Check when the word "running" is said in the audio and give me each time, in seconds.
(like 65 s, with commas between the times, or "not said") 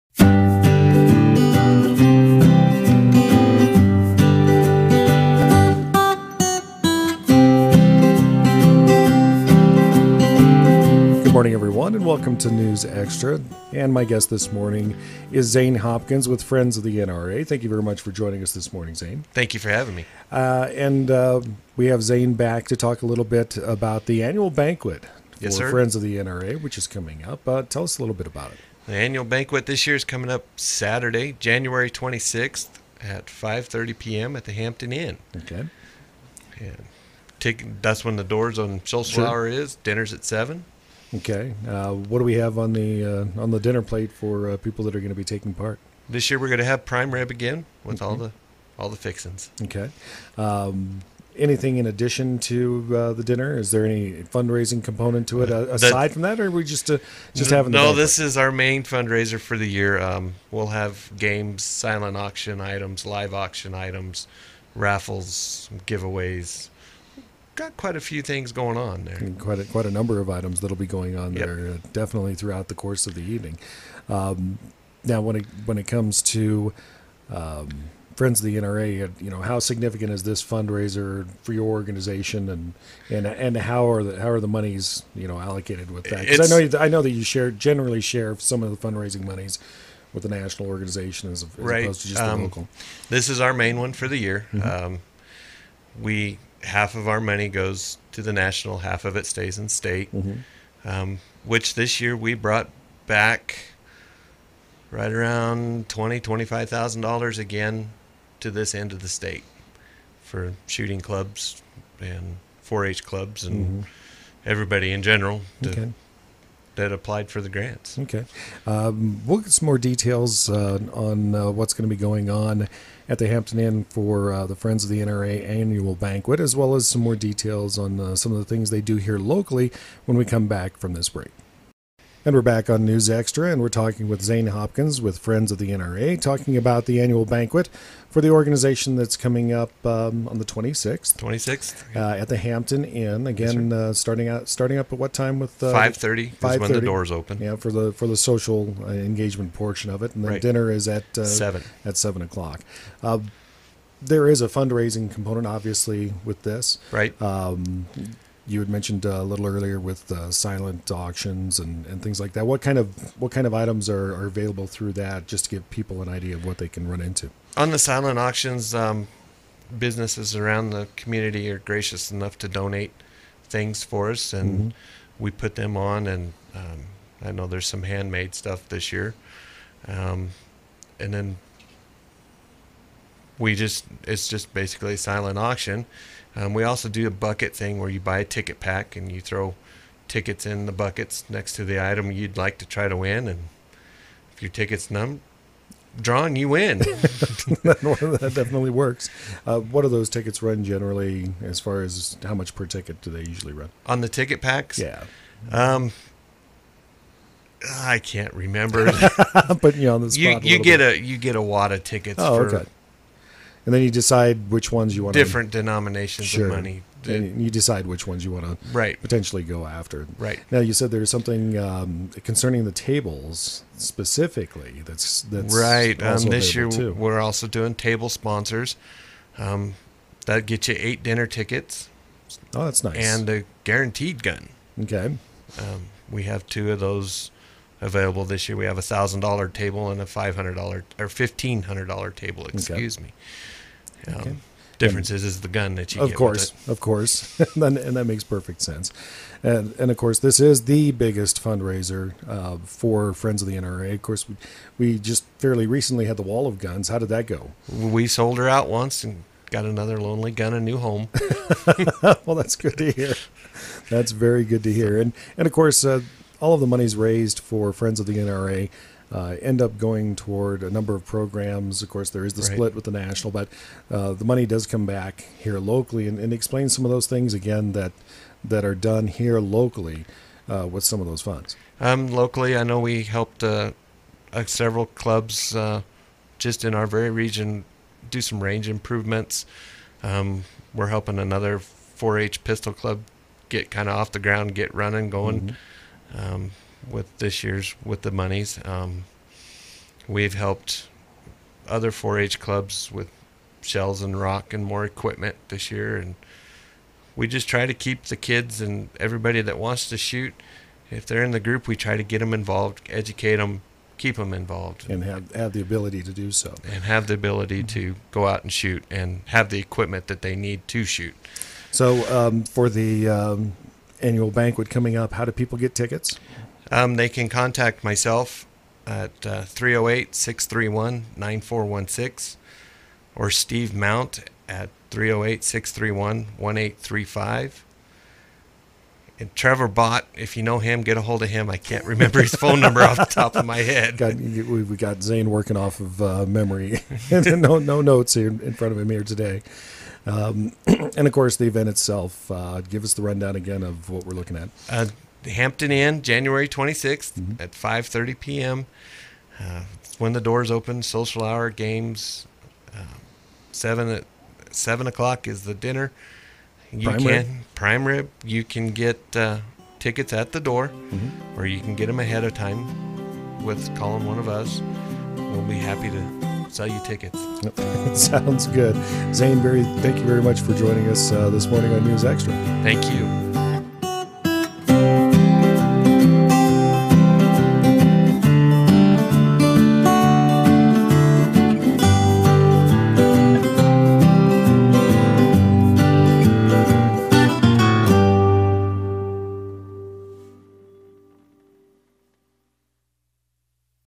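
294 s.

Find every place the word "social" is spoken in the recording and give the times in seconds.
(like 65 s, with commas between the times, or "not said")
148 s, 360 s.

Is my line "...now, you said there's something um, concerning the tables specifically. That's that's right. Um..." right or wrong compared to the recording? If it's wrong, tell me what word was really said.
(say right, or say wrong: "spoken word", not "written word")
right.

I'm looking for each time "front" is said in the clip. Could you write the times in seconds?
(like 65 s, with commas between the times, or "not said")
348 s.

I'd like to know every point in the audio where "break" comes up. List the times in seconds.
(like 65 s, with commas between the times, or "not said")
131 s.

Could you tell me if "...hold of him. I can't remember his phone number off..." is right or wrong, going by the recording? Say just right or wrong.
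right.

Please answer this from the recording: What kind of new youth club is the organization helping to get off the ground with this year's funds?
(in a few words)
4-H pistol club.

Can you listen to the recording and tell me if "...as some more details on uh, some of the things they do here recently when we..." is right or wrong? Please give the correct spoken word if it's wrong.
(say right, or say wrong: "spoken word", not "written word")
wrong: "locally", not "recently".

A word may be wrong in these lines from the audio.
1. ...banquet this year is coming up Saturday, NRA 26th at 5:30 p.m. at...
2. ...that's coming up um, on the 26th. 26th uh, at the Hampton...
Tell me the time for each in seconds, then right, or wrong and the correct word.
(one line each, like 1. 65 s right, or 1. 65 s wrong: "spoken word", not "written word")
1. 29 s wrong: "January", not "NRA"
2. 138 s right.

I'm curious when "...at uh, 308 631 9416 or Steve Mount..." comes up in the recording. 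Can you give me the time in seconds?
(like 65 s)
328 s.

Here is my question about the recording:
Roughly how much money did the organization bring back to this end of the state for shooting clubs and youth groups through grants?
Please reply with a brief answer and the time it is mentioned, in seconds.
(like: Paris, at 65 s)
$25,000, at 105 s.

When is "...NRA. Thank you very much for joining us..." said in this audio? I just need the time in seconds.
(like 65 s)
16 s.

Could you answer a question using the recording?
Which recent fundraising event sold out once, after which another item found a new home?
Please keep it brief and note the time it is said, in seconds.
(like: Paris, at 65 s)
Wall of Guns, at 256 s.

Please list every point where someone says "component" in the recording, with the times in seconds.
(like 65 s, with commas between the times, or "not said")
54 s, 155 s.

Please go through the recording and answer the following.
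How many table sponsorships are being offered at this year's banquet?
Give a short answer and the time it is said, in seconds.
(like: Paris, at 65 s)
2, at 236 s.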